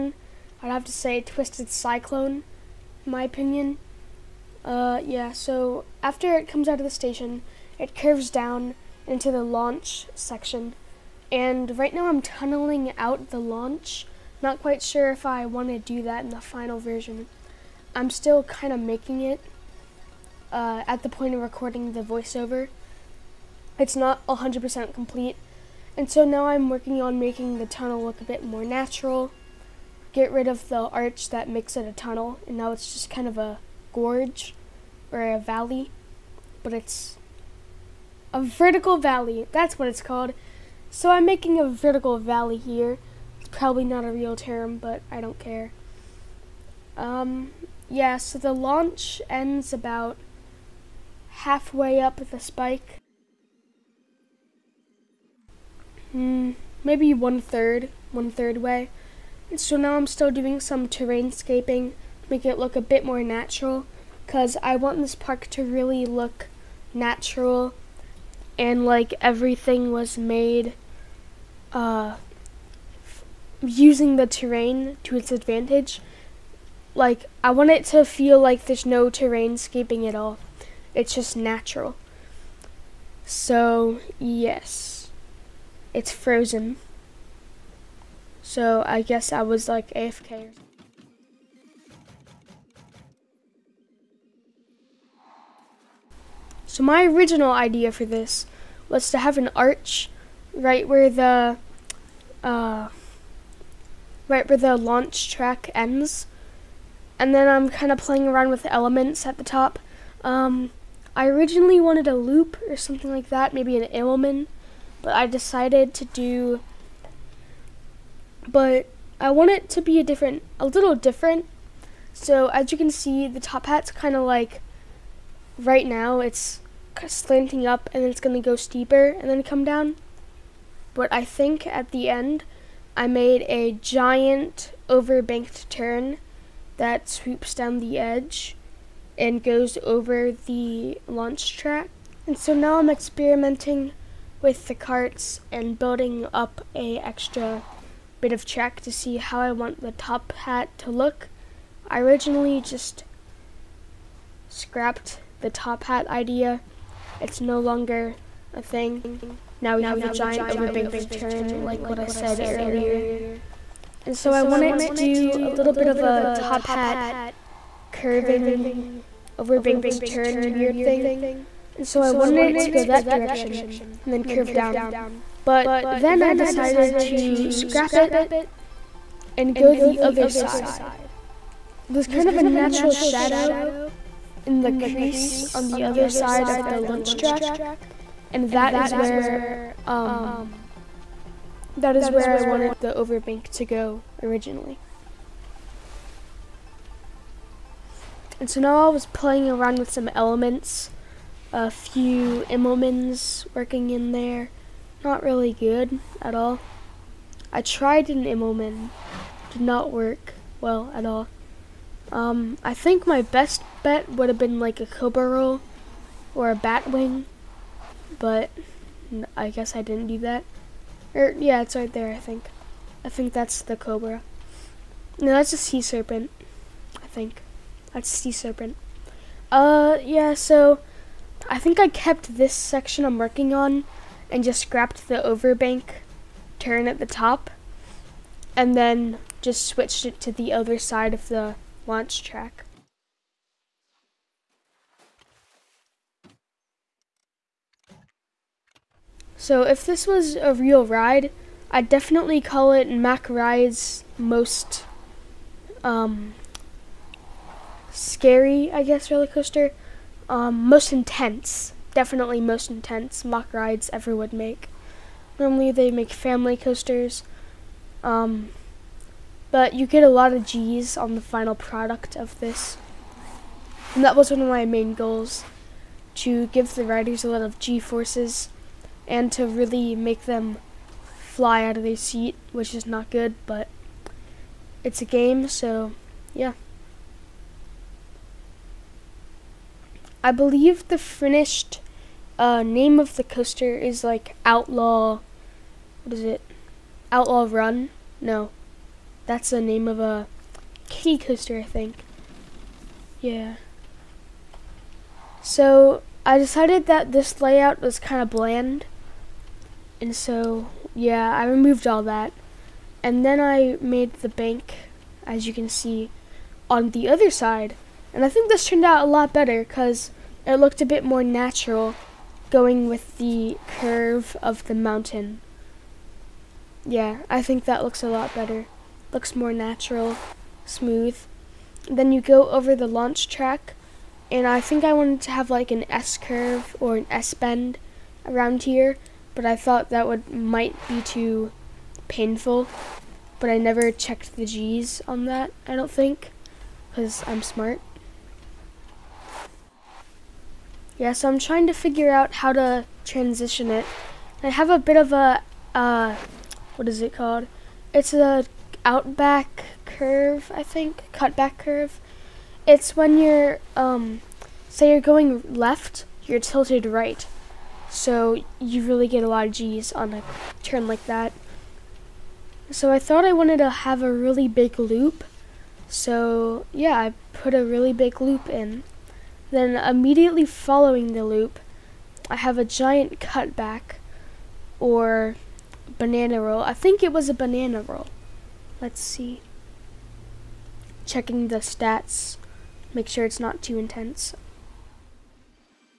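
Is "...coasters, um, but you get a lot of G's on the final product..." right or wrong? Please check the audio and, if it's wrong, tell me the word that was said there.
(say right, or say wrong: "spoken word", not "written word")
right.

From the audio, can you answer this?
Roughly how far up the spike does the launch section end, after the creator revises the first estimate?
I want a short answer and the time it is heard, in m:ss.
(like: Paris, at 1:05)
one third, at 0:58.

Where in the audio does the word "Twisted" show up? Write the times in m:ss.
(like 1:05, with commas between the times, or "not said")
0:01.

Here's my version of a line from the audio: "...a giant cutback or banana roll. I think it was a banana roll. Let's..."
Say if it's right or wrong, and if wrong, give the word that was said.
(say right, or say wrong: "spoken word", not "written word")
right.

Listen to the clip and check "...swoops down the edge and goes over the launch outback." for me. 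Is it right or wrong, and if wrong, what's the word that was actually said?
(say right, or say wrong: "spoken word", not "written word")
wrong: "track", not "outback".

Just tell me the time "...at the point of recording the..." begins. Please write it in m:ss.
0:20.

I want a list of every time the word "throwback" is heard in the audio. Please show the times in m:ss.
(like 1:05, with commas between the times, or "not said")
not said.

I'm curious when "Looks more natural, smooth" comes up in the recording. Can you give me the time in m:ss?
5:29.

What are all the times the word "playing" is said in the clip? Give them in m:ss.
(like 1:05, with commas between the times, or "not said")
1:47, 3:19.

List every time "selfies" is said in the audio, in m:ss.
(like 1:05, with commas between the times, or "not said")
not said.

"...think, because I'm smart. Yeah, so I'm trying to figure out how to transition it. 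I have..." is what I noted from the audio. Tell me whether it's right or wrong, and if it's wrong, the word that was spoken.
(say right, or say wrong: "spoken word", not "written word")
right.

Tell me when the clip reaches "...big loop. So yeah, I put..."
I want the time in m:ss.
6:14.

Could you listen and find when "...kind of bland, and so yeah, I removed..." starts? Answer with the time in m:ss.
5:07.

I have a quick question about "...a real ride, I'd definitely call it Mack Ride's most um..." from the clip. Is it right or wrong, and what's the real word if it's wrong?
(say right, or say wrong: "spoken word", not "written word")
right.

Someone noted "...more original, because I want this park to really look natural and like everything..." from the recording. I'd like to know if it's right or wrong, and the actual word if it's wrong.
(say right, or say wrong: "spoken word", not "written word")
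wrong: "natural", not "original".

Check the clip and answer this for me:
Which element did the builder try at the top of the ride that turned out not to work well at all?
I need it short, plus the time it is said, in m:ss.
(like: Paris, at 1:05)
Immelman, at 3:27.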